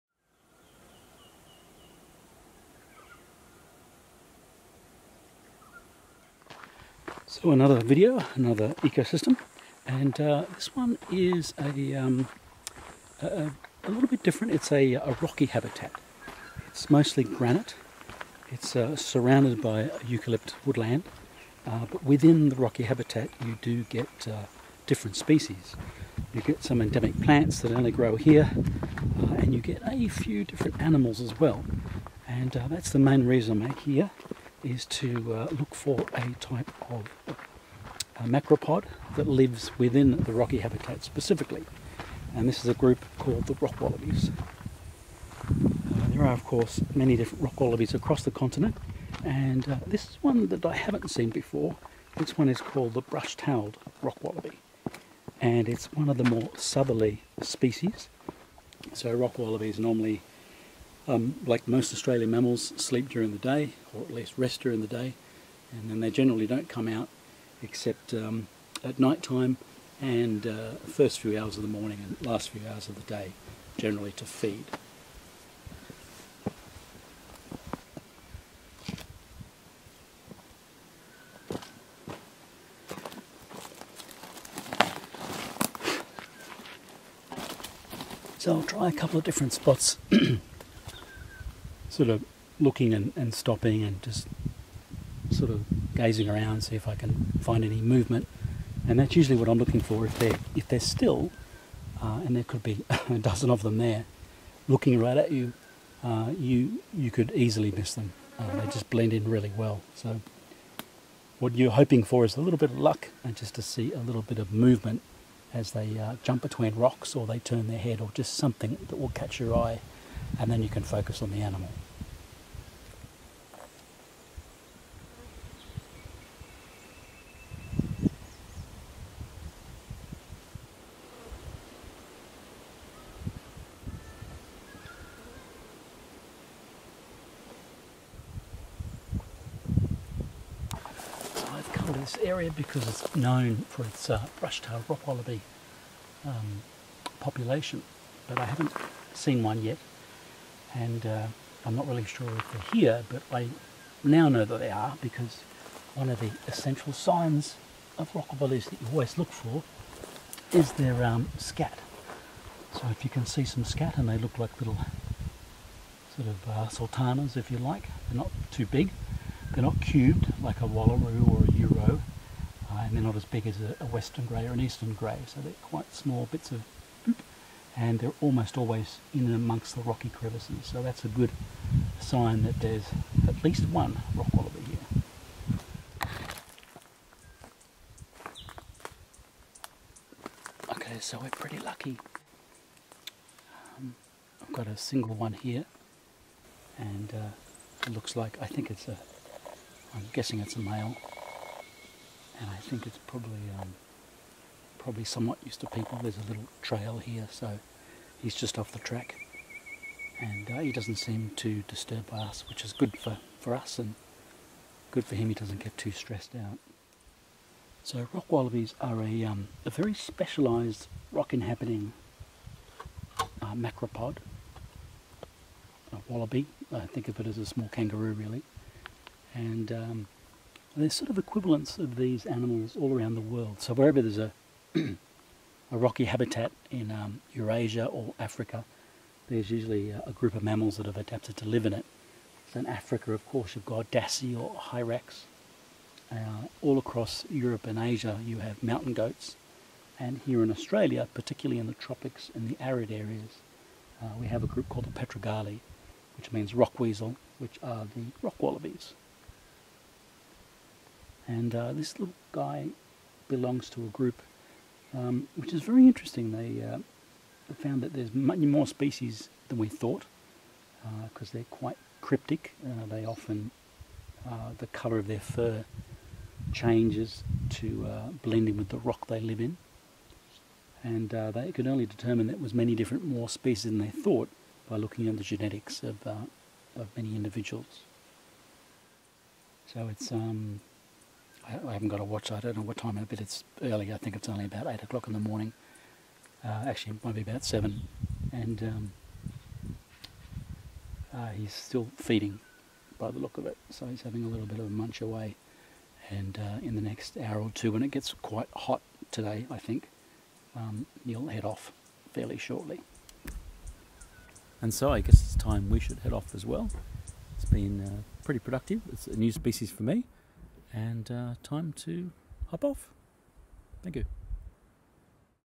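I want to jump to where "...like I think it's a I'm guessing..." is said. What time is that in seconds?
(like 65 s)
198 s.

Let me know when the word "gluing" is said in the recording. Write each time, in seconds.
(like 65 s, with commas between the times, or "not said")
not said.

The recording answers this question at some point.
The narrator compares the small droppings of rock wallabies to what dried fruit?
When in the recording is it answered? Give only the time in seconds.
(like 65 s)
166 s.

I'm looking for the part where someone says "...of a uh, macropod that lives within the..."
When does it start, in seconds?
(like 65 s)
36 s.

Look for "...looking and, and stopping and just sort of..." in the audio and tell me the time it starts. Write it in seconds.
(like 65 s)
92 s.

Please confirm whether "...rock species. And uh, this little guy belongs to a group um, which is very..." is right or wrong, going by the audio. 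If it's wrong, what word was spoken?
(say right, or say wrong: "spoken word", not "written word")
wrong: "wallabies", not "species".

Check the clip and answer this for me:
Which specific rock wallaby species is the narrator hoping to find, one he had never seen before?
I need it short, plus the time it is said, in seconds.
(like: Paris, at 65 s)
Brush-tailed rock wallaby, at 53 s.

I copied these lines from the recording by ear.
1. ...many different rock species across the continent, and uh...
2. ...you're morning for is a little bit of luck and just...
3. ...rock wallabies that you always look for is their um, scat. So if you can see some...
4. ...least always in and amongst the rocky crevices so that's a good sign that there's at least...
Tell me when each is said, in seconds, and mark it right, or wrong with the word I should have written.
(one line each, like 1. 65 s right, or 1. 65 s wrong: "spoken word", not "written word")
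1. 46 s wrong: "wallabies", not "species"
2. 111 s wrong: "hoping", not "morning"
3. 158 s right
4. 178 s wrong: "almost", not "least".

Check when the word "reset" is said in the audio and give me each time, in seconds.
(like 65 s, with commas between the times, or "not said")
not said.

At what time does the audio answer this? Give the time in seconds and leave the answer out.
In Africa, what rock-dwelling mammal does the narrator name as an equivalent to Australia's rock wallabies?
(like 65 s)
243 s.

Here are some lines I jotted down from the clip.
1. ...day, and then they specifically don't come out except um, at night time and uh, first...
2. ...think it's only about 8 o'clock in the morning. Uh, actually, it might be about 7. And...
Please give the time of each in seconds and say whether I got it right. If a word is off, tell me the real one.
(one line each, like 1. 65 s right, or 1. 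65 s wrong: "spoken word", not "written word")
1. 64 s wrong: "generally", not "specifically"
2. 293 s right.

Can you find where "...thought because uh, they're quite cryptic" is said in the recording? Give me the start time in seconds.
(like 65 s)
269 s.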